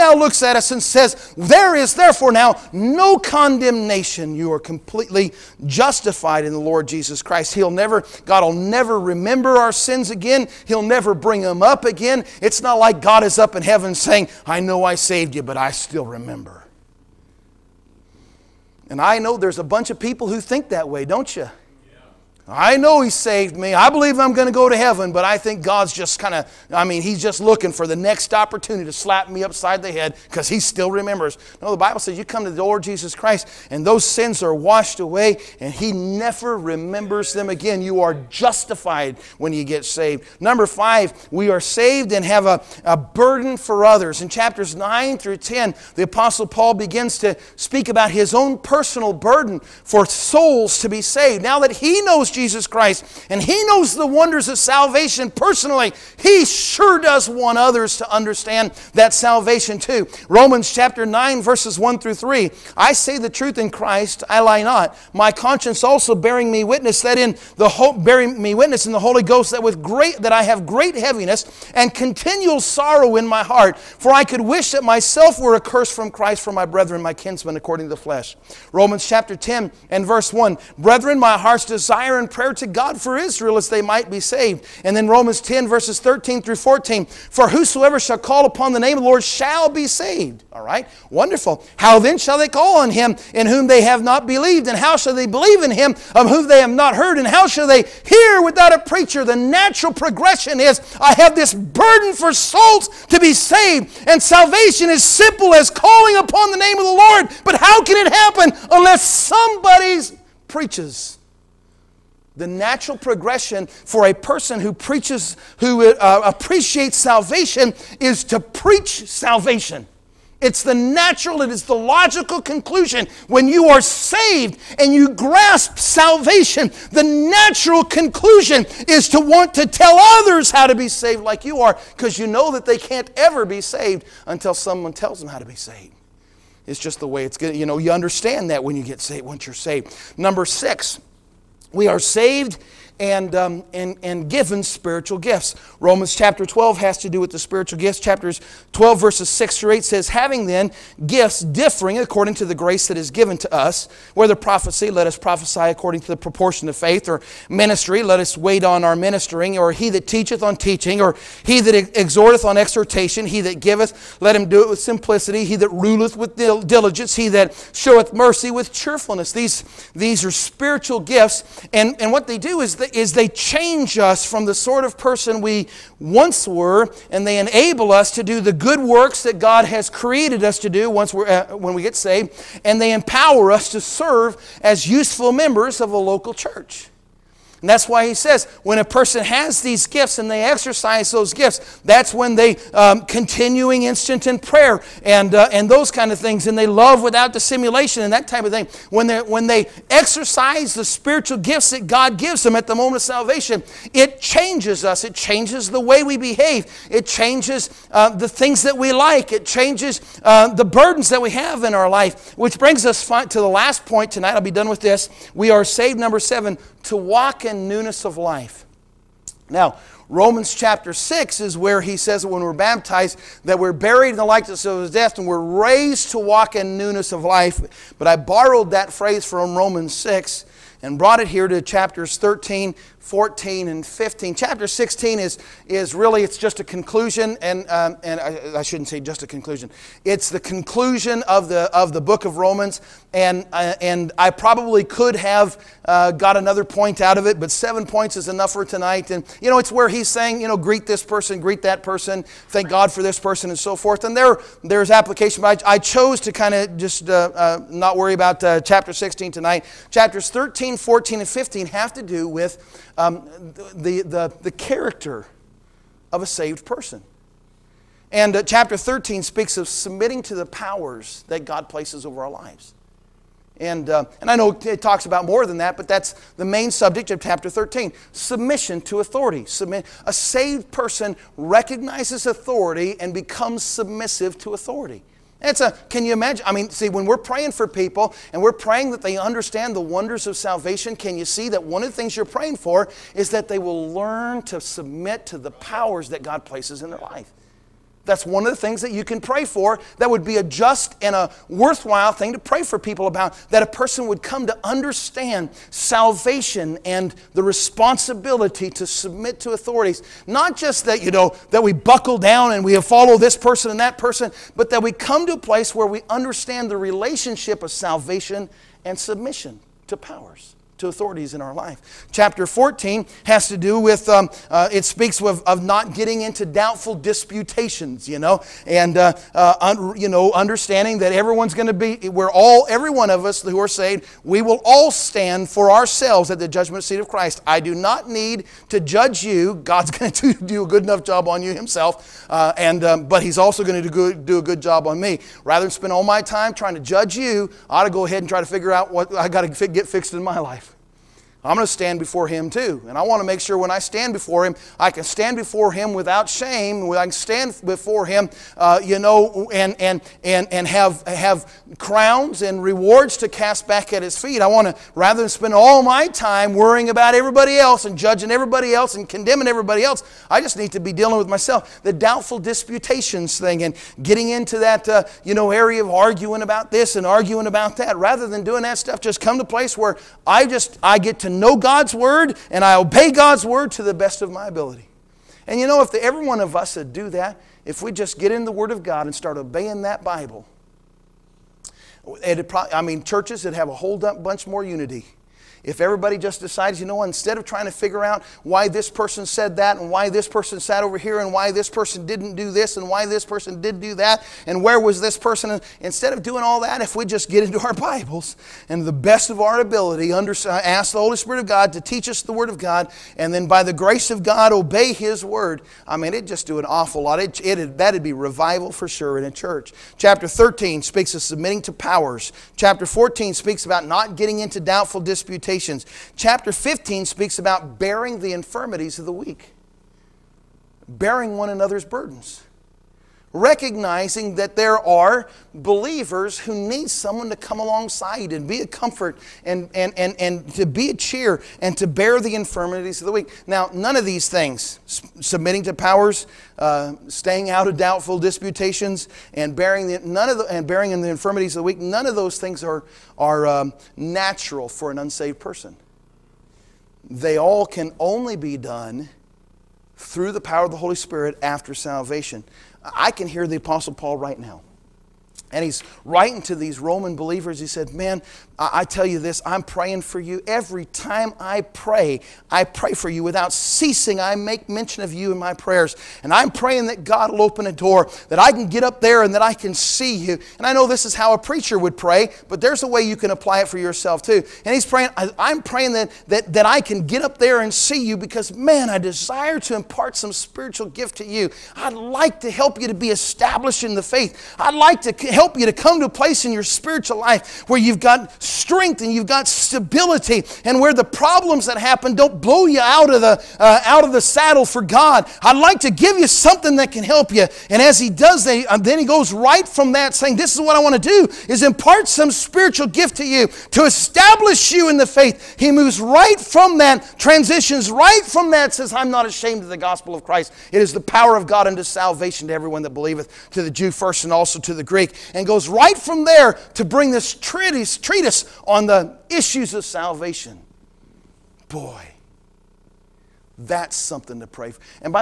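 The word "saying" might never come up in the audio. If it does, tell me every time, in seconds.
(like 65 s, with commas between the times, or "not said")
13 s, 250 s, 510 s.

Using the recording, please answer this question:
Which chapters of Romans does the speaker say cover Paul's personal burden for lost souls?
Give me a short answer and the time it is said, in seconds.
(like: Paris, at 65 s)
Chapters 9 through 10, at 44 s.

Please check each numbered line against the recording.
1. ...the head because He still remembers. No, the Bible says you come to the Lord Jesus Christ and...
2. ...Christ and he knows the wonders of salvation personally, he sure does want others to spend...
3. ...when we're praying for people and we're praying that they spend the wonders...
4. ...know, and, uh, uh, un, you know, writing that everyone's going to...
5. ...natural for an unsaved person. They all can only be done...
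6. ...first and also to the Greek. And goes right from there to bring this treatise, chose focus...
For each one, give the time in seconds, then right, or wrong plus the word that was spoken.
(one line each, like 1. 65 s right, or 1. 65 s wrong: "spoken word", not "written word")
1. 29 s right
2. 52 s wrong: "understand", not "spend"
3. 286 s wrong: "understand", not "spend"
4. 328 s wrong: "understanding", not "writing"
5. 453 s right
6. 523 s wrong: "treatise", not "chose".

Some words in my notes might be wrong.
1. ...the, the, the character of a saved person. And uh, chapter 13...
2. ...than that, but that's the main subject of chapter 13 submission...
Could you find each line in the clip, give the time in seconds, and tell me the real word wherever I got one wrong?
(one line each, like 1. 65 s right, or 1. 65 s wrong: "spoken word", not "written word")
1. 263 s right
2. 275 s right.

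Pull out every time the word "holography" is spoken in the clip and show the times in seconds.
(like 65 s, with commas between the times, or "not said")
not said.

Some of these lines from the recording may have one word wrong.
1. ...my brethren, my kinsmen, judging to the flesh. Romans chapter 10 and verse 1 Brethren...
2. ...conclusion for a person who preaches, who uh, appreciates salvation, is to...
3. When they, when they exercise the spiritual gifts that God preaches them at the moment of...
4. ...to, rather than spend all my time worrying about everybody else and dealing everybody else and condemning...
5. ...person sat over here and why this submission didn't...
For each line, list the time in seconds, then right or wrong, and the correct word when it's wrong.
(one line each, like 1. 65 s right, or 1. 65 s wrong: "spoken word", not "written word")
1. 76 s wrong: "according", not "judging"
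2. 112 s wrong: "progression", not "conclusion"
3. 198 s wrong: "gives", not "preaches"
4. 364 s wrong: "judging", not "dealing"
5. 400 s wrong: "person", not "submission".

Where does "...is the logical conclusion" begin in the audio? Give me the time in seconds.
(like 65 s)
121 s.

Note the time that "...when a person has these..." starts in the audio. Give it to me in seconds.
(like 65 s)
188 s.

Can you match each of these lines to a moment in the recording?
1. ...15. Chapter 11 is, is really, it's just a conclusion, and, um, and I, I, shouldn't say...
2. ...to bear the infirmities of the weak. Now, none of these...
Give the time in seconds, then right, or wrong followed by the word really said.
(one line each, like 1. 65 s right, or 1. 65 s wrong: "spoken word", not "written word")
1. 233 s wrong: "16", not "11"
2. 441 s right.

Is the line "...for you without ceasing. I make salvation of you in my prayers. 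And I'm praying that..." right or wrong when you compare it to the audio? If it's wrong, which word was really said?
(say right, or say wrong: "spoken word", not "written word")
wrong: "mention", not "salvation".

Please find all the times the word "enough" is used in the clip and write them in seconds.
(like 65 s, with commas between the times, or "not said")
248 s, 340 s.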